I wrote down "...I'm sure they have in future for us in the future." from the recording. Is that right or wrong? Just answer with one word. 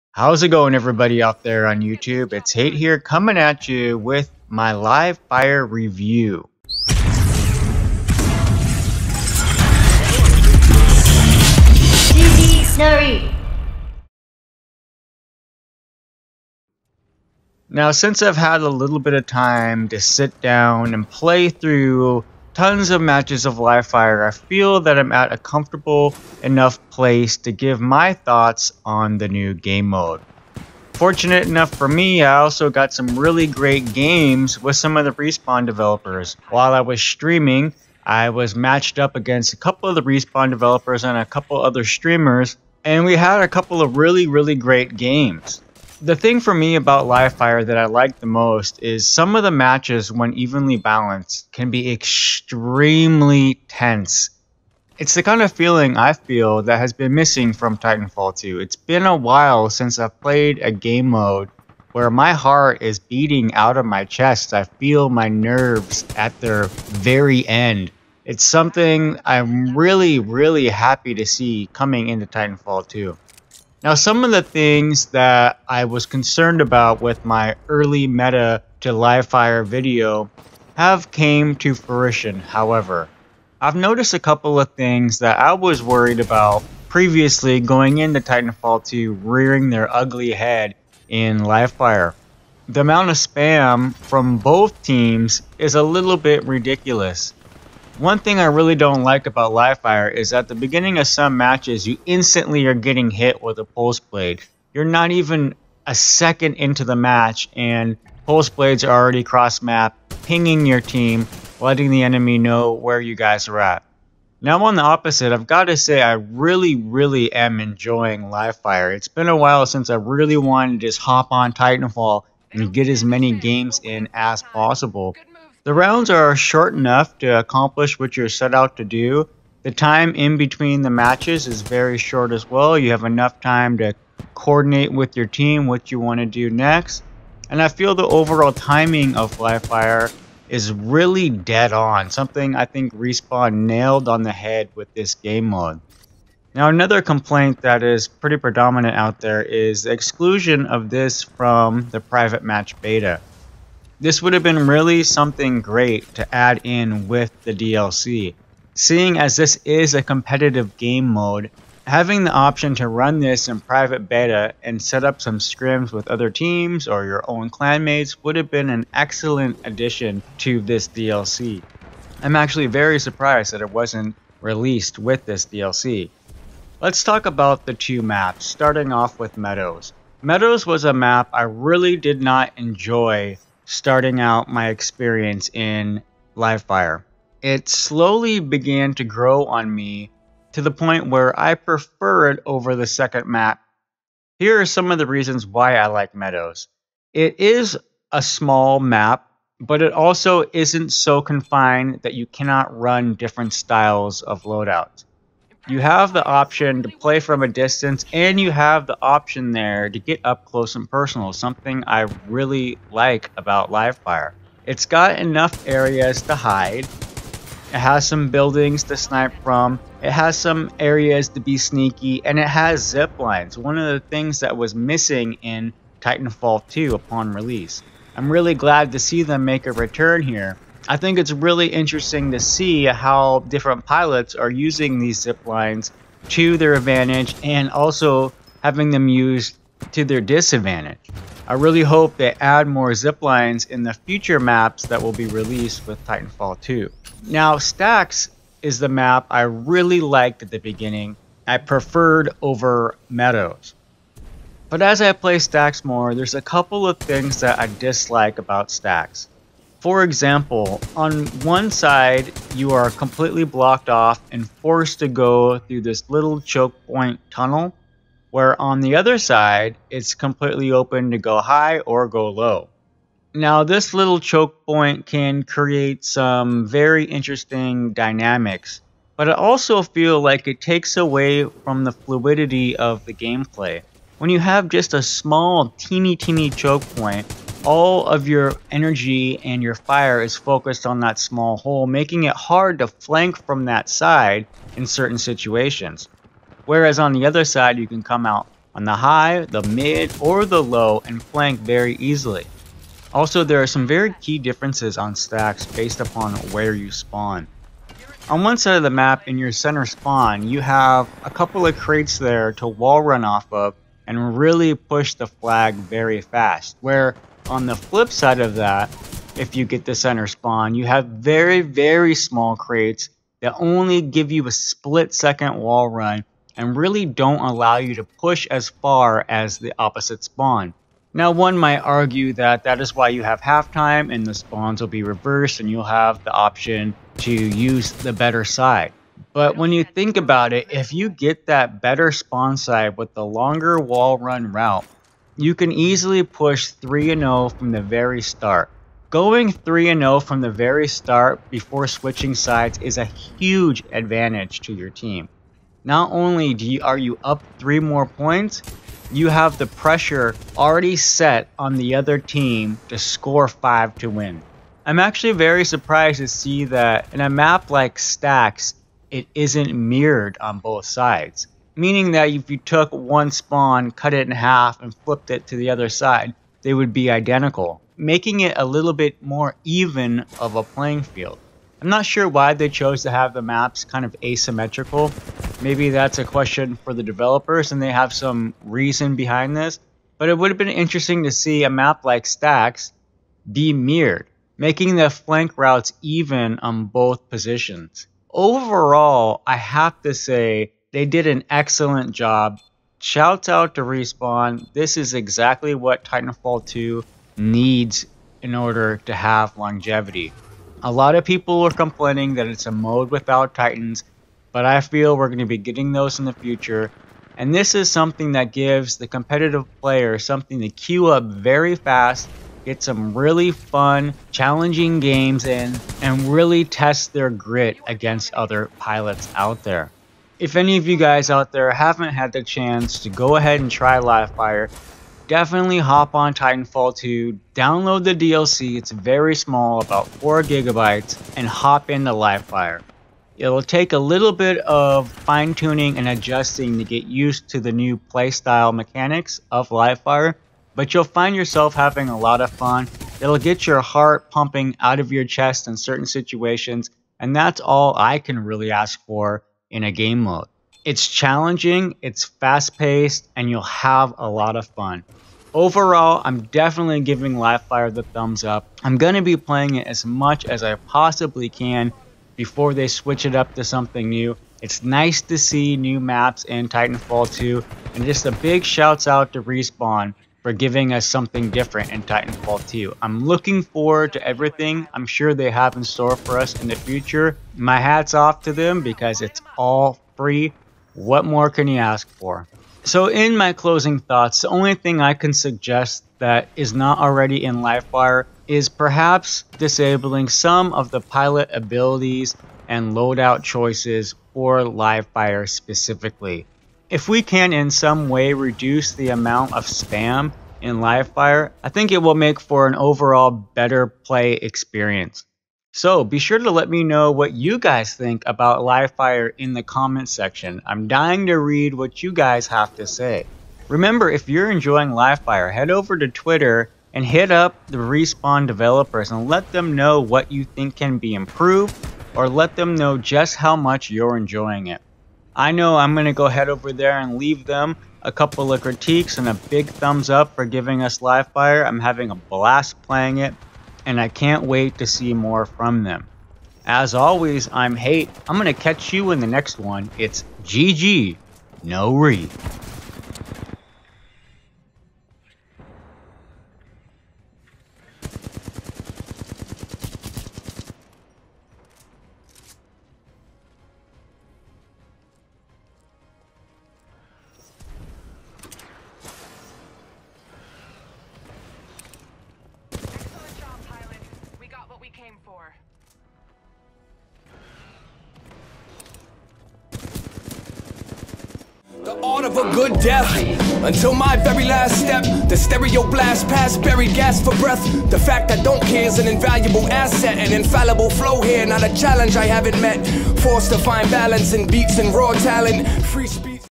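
wrong.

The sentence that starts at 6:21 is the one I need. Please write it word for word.
I'm not sure why they chose to have the maps kind of asymmetrical.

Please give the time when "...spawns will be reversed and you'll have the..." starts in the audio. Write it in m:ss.
5:34.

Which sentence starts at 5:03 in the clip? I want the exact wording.
Also, there are some very key differences on stacks based upon where you spawn.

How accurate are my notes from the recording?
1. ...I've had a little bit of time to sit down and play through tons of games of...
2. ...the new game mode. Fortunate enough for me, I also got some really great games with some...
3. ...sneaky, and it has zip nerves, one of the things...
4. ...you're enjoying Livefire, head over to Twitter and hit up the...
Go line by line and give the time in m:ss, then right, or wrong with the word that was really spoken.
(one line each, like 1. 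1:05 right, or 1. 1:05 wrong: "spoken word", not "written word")
1. 0:18 wrong: "matches", not "games"
2. 0:29 right
3. 3:41 wrong: "lines", not "nerves"
4. 8:44 right.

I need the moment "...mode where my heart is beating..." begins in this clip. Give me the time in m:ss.
1:01.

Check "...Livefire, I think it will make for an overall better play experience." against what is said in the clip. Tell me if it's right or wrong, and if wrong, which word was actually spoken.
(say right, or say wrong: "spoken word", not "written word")
right.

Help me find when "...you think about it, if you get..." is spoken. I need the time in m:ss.
5:39.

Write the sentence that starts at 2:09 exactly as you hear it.
The time in between the matches is very short as well.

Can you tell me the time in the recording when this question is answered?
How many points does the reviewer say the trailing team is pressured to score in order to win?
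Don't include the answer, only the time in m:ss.
6:03.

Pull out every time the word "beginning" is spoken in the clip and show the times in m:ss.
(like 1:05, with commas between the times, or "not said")
1:40, 4:10.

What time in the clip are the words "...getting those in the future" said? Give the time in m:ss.
6:55.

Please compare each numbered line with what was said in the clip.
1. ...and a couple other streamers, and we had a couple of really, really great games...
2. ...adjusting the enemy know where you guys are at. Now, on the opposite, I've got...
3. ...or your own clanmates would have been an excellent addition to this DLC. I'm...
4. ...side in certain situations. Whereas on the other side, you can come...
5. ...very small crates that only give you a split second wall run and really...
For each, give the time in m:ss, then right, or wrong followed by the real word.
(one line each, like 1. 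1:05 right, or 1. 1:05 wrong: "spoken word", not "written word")
1. 0:41 right
2. 1:51 wrong: "letting", not "adjusting"
3. 2:46 right
4. 4:53 right
5. 5:21 right.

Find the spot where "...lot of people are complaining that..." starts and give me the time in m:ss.
6:50.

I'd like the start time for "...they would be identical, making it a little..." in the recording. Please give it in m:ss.
6:16.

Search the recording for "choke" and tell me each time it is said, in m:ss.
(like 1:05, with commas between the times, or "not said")
4:26, 4:34, 4:46.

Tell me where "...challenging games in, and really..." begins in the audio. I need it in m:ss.
7:04.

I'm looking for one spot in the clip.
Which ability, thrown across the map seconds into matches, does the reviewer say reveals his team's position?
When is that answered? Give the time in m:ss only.
1:43.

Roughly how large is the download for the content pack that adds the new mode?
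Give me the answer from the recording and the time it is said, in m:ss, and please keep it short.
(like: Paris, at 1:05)
4 gigabytes, at 7:20.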